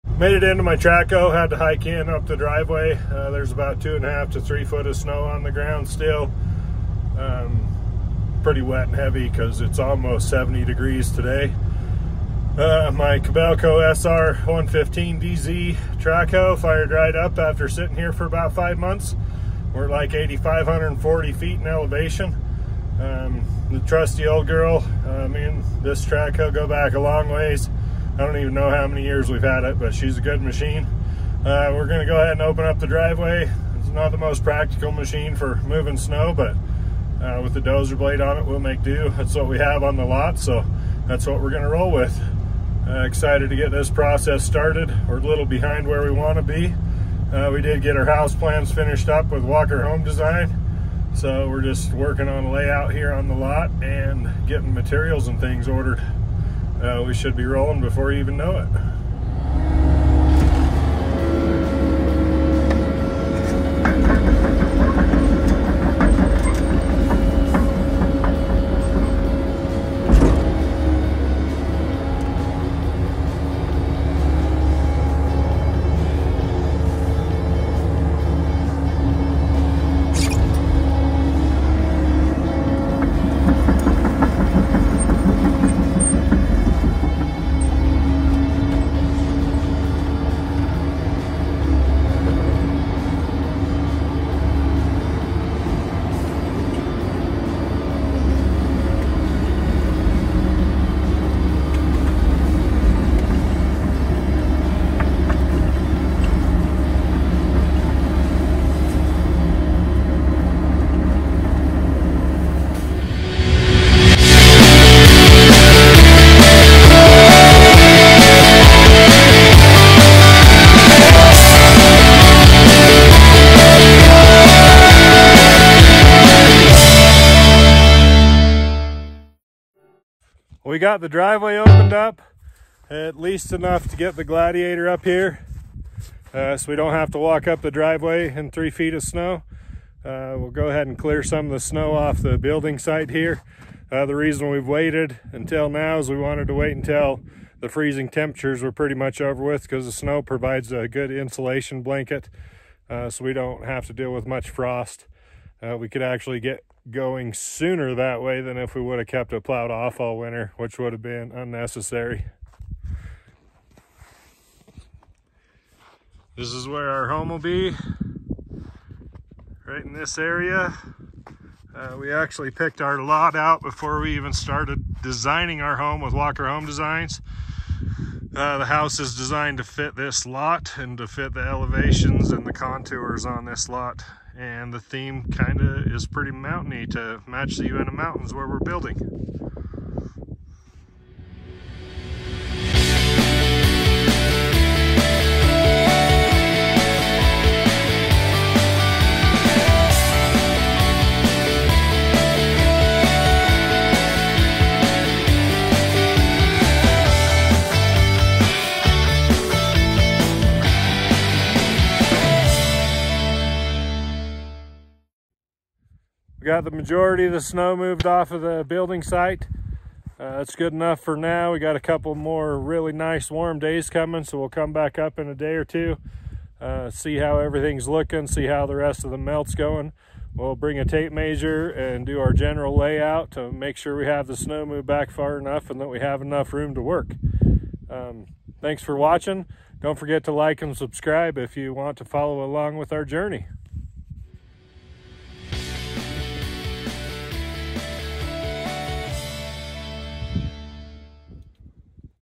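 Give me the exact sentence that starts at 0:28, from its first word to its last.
I don't even know how many years we've had it, but she's a good machine.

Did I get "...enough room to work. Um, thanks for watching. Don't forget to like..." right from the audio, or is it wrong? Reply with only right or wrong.
right.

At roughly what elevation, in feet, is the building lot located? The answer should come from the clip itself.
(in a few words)
8,540 feet.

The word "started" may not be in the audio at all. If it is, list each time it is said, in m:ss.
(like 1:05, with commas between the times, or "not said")
0:44, 2:54.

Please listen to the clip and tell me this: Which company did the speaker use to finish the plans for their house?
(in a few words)
Walker Home Design.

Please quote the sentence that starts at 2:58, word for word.
Uh, the house is designed to fit this lot and to fit the elevations and the contours on this lot.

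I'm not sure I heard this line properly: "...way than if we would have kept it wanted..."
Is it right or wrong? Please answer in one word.
wrong.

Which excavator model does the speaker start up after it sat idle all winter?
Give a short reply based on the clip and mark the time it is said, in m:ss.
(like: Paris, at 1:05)
Kobelco SR 115DZ, at 0:13.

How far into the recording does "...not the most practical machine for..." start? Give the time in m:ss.
0:33.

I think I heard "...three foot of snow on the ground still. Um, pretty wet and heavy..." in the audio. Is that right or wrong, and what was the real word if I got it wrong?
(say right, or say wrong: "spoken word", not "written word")
right.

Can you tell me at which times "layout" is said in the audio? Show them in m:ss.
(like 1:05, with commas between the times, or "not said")
0:52, 3:52.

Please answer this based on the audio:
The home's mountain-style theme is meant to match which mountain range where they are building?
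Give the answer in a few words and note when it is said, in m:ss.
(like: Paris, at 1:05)
Uinta Mountains, at 3:07.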